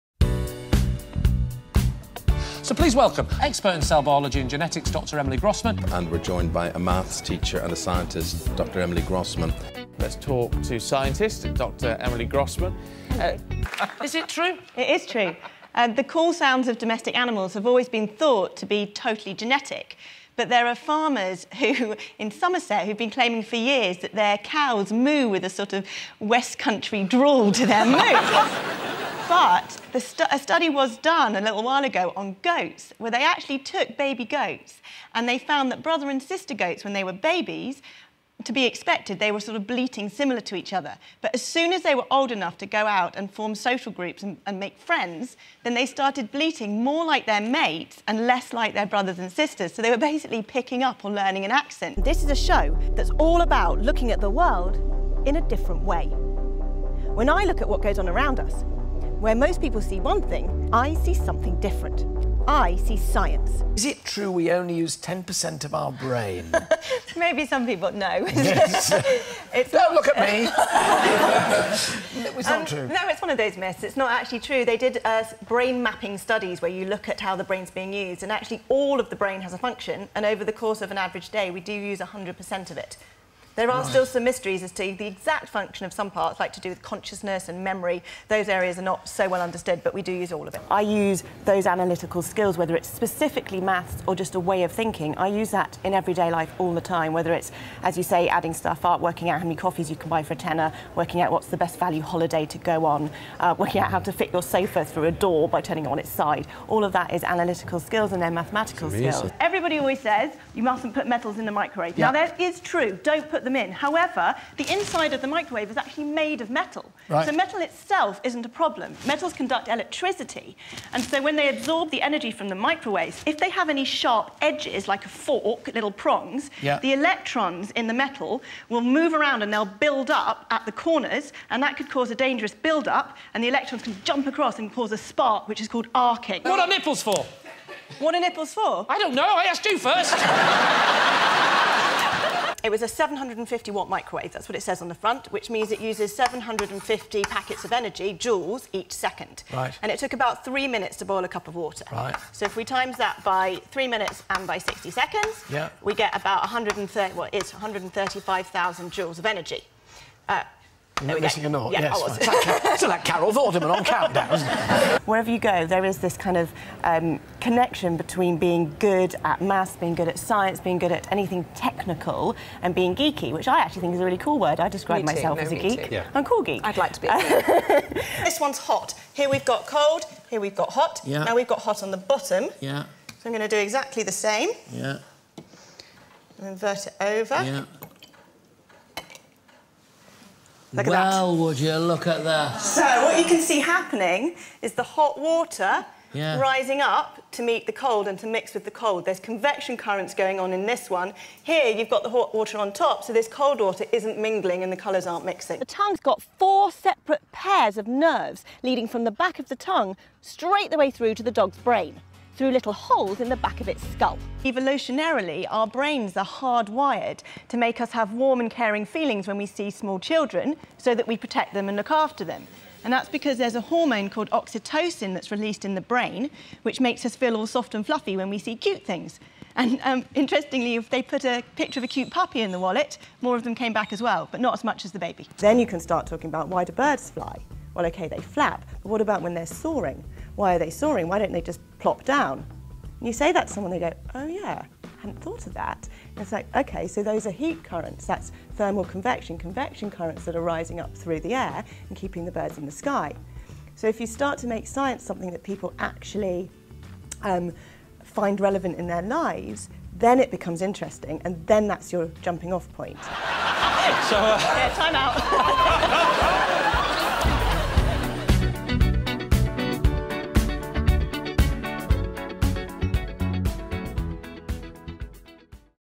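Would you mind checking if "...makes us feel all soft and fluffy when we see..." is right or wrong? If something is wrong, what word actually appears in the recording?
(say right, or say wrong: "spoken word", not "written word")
right.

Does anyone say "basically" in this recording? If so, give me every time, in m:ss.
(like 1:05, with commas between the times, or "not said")
0:49.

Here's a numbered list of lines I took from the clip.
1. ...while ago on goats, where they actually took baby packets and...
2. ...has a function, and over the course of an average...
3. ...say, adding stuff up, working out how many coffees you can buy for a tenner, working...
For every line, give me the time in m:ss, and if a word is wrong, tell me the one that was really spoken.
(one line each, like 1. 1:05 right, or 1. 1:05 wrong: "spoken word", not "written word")
1. 0:31 wrong: "goats", not "packets"
2. 1:19 right
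3. 1:38 right.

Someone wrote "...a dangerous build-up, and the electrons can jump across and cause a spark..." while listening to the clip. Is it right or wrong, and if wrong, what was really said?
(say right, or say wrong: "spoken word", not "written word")
right.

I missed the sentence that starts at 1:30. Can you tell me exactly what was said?
I use those analytical skills, whether it's specifically maths or just a way of thinking.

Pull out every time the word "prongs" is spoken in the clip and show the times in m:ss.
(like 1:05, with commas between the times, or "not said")
2:05.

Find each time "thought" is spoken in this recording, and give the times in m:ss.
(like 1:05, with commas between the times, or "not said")
0:18, 4:05.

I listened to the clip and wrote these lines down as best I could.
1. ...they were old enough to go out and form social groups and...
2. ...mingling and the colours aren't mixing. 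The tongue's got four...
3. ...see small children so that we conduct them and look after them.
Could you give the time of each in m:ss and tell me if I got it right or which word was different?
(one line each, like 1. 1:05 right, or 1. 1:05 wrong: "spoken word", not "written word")
1. 0:41 right
2. 3:24 right
3. 3:39 wrong: "protect", not "conduct".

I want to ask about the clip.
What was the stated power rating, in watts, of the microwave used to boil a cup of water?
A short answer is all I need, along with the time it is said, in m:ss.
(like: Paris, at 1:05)
750, at 2:22.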